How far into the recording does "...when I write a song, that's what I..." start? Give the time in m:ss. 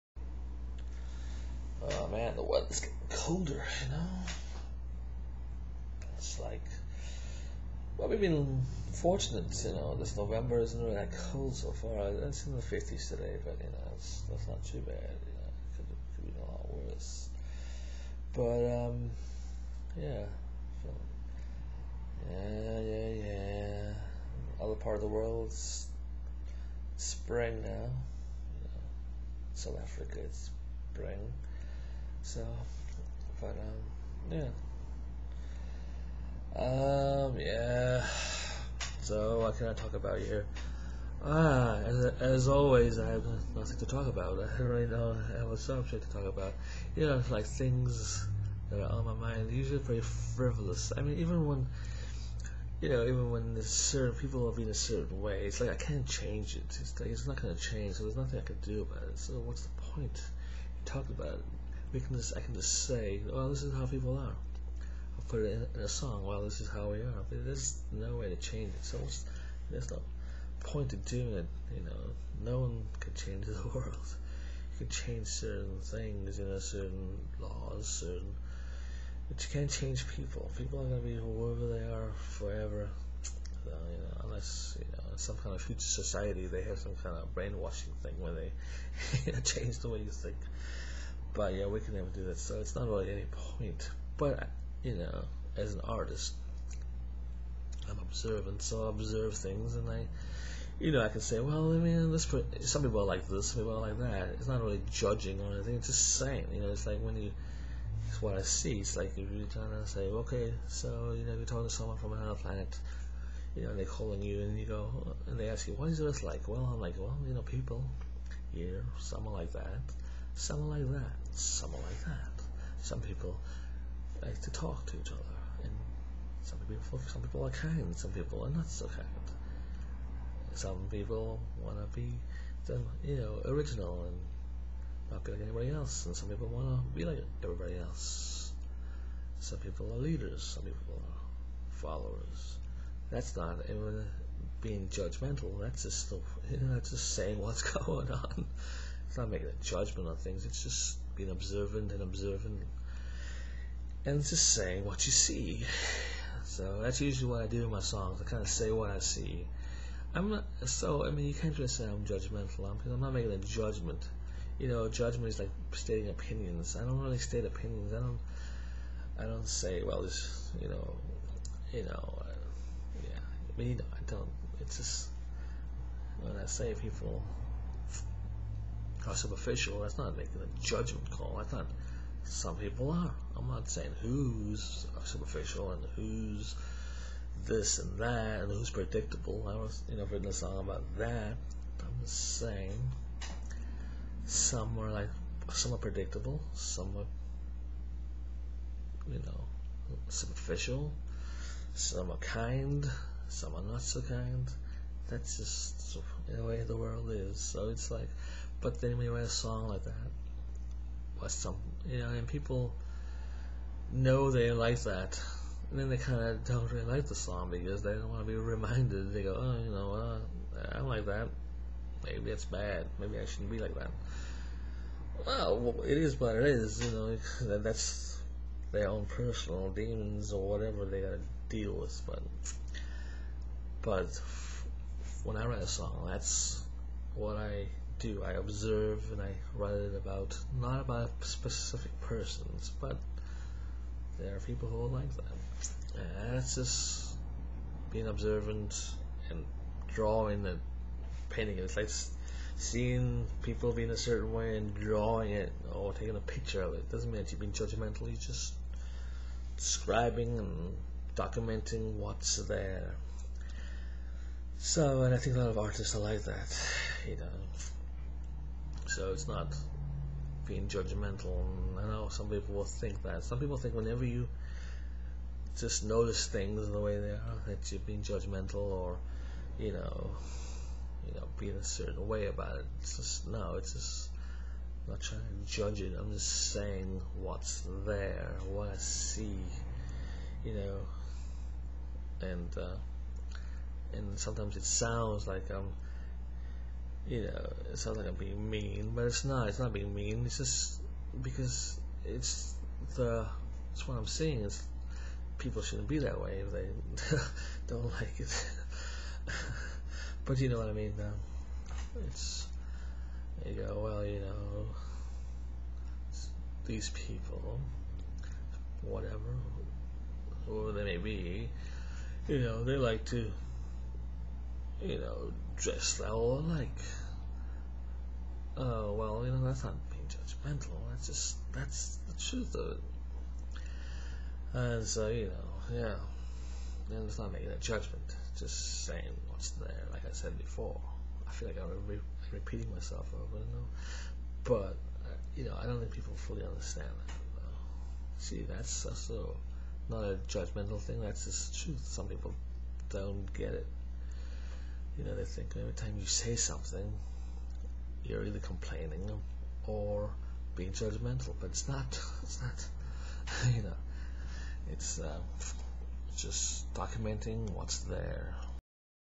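3:55.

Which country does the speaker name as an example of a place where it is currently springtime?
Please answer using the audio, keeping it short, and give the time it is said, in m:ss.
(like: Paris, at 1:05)
South Africa, at 0:29.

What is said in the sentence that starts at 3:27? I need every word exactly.
So it's like but then we write a song like that was some, you know, and people know they like that.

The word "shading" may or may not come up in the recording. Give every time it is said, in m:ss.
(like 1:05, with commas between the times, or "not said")
not said.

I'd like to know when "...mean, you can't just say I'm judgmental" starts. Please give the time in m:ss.
2:41.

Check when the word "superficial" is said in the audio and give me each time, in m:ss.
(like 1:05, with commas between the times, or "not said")
3:05, 3:20.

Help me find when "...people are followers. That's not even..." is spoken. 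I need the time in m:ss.
2:20.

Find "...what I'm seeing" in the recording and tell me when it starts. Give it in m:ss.
5:03.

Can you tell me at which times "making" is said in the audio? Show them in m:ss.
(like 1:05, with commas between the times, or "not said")
2:29, 2:43, 3:00, 5:37.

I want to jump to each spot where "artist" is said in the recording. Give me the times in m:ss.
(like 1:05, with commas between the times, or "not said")
1:35, 4:25.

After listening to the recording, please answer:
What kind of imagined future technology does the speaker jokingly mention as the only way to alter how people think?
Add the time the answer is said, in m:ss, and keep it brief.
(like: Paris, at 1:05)
Brainwashing, at 1:27.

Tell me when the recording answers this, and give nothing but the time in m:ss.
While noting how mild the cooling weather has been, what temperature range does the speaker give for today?
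0:12.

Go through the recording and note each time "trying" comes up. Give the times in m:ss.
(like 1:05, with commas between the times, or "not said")
1:49, 4:45.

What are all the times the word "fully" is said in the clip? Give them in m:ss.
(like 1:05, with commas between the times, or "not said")
5:46.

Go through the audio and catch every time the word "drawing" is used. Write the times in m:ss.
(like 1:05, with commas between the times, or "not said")
4:09, 4:14.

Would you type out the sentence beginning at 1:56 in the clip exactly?
Well, I'm like, well, you know, people here, someone like that some like that, some like that.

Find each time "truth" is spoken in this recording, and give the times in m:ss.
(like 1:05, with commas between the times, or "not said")
5:32, 5:51.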